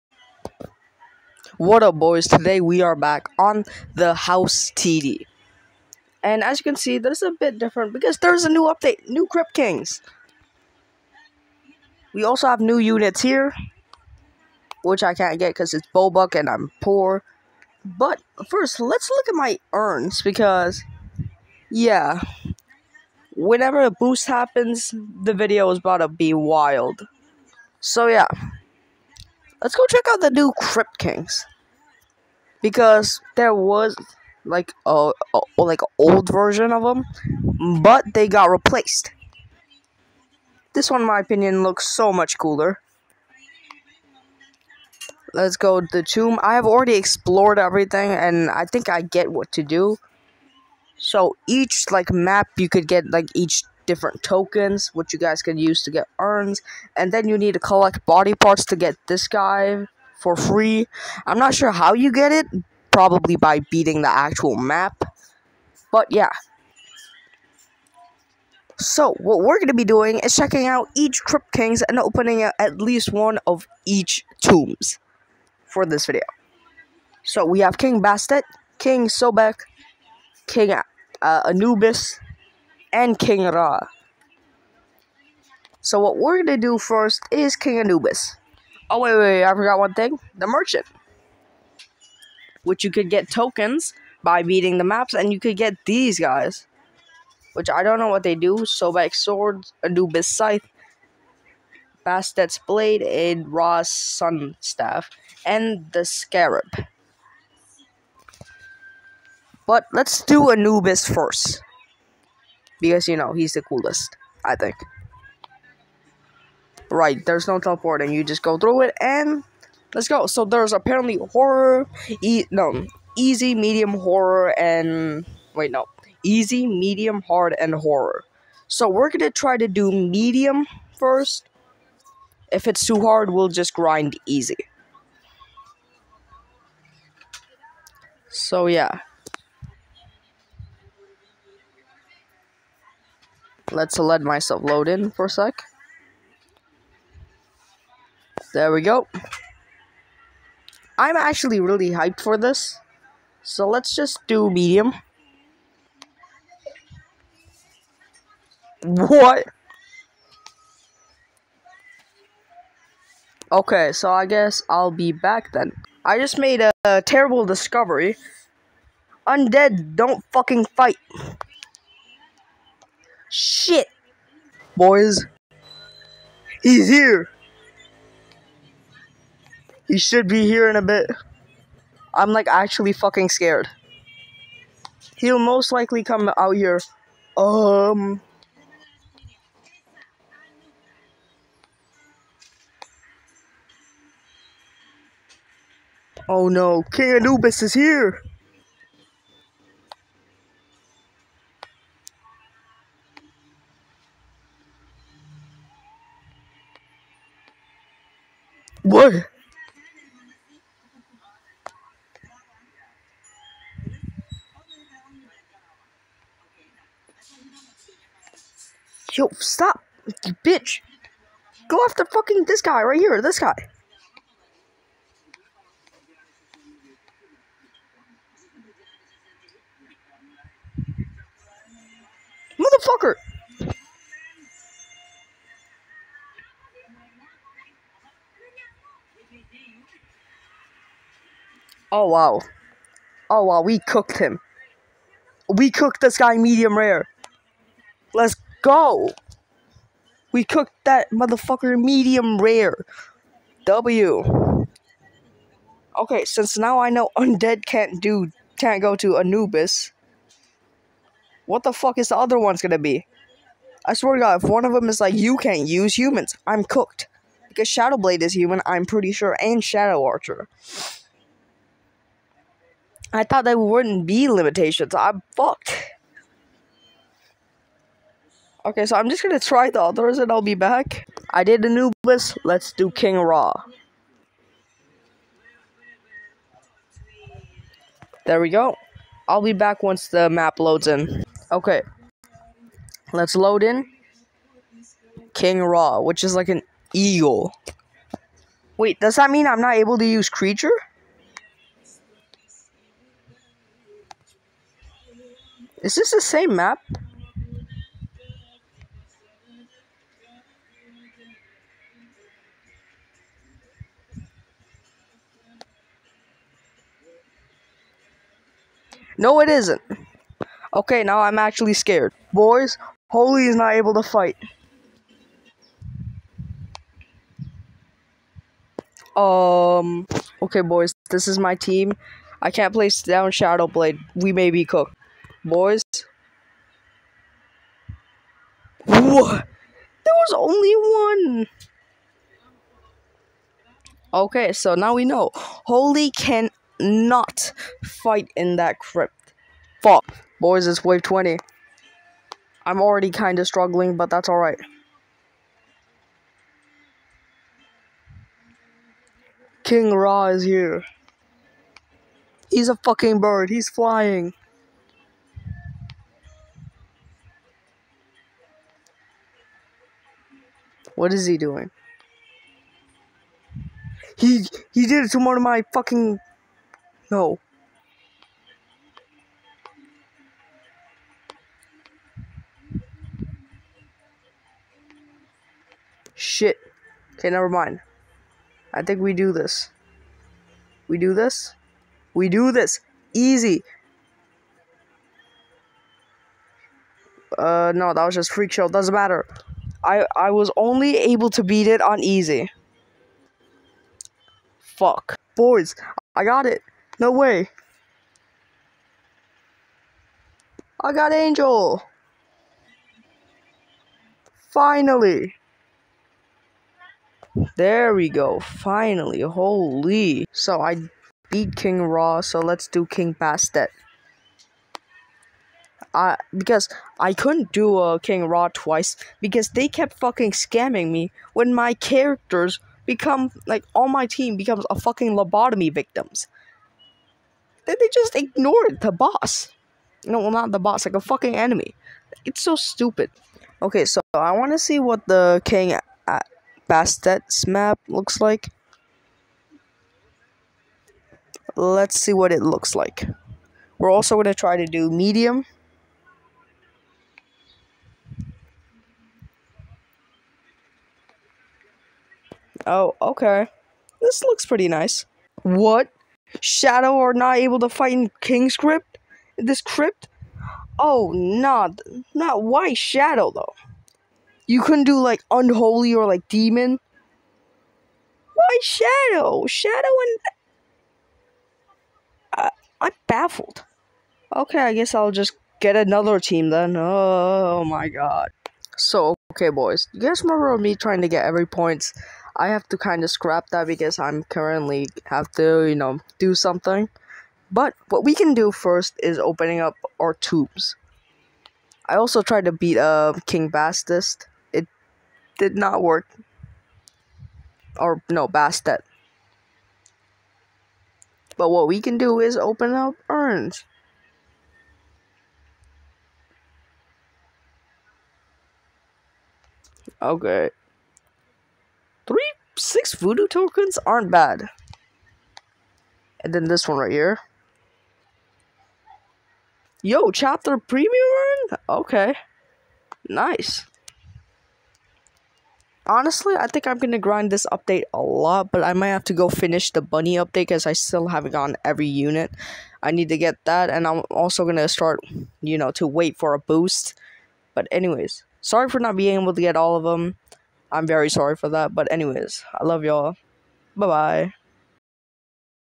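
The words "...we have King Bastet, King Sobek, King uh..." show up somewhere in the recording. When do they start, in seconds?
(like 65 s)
77 s.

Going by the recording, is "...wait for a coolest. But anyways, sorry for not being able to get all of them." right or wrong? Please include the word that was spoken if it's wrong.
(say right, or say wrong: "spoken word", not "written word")
wrong: "boost", not "coolest".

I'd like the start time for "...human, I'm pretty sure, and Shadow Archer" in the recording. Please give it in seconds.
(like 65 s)
268 s.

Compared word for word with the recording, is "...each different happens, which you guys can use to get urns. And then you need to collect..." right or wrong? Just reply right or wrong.
wrong.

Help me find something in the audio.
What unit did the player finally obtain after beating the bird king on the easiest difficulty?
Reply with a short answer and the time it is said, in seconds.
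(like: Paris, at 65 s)
Angel, at 410 s.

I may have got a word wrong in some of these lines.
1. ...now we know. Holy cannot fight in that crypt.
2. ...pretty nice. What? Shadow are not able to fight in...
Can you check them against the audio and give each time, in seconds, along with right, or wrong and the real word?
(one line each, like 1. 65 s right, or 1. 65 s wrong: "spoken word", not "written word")
1. 344 s right
2. 464 s right.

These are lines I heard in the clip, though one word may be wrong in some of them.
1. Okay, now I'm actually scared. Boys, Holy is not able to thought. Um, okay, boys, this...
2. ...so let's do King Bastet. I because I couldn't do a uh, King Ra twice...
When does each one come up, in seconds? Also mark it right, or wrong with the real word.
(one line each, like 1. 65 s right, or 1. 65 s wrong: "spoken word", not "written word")
1. 320 s wrong: "fight", not "thought"
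2. 422 s right.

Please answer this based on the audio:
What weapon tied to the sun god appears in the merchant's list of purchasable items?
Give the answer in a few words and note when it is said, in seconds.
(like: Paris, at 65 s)
Ra's Sun Staff, at 103 s.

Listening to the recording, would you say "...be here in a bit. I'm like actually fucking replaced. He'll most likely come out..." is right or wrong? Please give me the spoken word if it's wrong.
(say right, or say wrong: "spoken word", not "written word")
wrong: "scared", not "replaced".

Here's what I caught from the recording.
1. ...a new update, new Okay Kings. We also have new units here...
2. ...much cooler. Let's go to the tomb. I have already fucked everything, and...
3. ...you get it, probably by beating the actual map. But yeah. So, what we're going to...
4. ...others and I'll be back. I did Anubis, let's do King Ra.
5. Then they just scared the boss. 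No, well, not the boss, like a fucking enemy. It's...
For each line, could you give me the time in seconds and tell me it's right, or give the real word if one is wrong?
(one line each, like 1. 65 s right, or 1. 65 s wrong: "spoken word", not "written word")
1. 8 s wrong: "Crypt", not "Okay"
2. 42 s wrong: "explored", not "fucked"
3. 61 s right
4. 279 s right
5. 437 s wrong: "ignored", not "scared".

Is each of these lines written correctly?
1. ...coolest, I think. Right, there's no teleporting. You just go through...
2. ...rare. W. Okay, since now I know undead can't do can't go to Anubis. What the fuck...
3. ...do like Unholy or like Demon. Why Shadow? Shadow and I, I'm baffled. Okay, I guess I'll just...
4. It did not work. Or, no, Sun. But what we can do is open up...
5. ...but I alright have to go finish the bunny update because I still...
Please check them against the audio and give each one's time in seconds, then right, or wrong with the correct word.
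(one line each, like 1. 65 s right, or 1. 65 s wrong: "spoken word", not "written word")
1. 113 s right
2. 252 s right
3. 474 s right
4. 504 s wrong: "Bastet", not "Sun"
5. 538 s wrong: "might", not "alright".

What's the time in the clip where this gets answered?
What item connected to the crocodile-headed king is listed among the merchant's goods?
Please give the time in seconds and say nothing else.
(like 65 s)
98 s.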